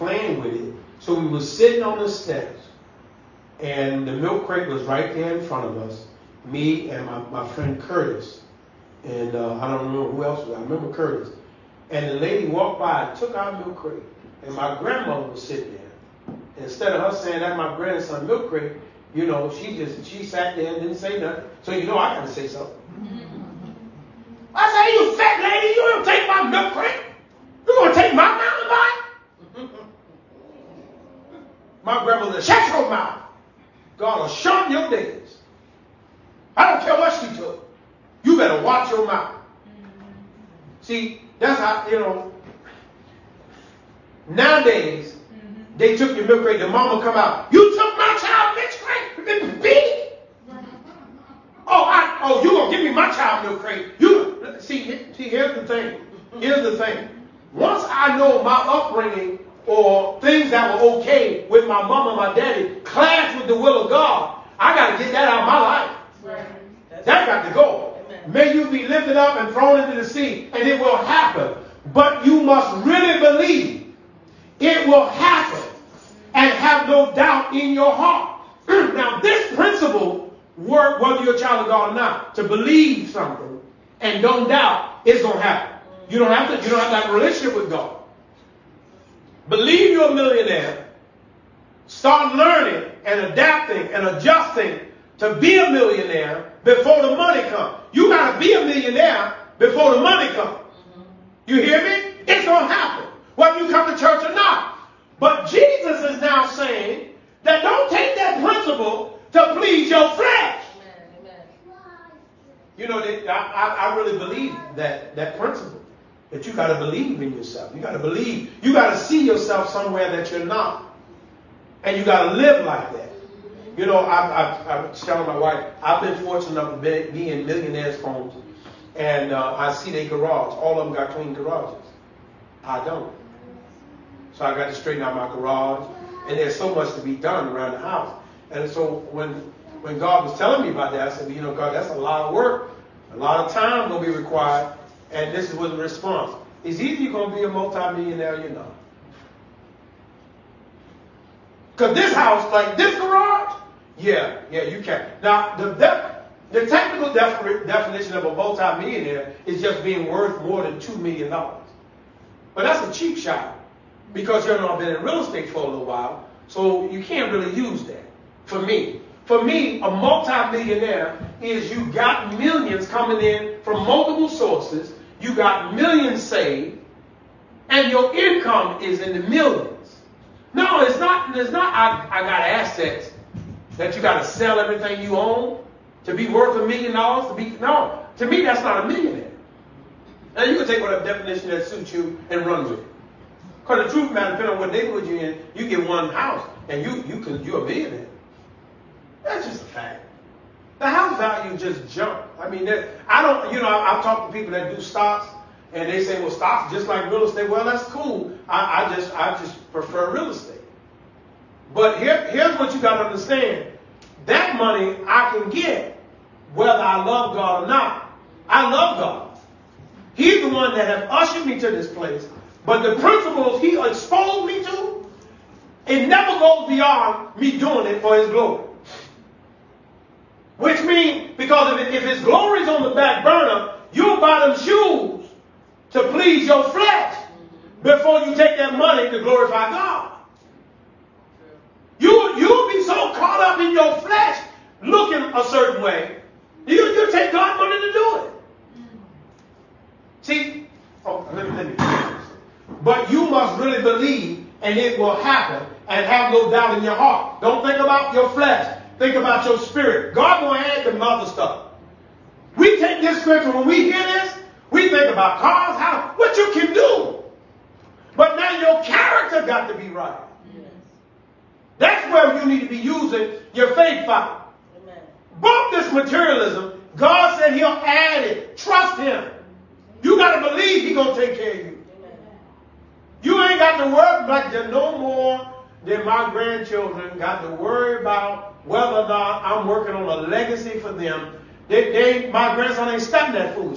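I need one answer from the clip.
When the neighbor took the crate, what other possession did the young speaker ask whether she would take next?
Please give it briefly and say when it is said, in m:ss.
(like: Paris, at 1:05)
mountain bike, at 0:29.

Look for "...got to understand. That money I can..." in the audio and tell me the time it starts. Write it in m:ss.
3:32.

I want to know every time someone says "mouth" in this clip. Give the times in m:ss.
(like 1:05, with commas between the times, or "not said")
0:32, 0:39.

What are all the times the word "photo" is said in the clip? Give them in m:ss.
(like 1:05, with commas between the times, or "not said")
not said.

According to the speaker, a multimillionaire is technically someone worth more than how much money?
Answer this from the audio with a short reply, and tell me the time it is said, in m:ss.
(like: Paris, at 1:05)
2 million dollars, at 2:40.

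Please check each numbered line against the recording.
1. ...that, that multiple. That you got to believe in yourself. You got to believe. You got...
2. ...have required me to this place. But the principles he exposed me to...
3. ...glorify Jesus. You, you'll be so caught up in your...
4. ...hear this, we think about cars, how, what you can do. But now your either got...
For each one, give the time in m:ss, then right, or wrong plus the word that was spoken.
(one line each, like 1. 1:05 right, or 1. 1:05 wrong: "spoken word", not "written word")
1. 1:54 wrong: "principle", not "multiple"
2. 3:40 wrong: "ushered", not "required"
3. 3:59 wrong: "God", not "Jesus"
4. 4:23 wrong: "character", not "either".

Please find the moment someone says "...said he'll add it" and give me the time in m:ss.
4:37.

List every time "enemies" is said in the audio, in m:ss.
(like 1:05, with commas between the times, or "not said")
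not said.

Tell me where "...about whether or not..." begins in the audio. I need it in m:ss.
4:48.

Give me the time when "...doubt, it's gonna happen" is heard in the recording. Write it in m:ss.
1:24.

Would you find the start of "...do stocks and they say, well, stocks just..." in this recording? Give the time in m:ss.
3:24.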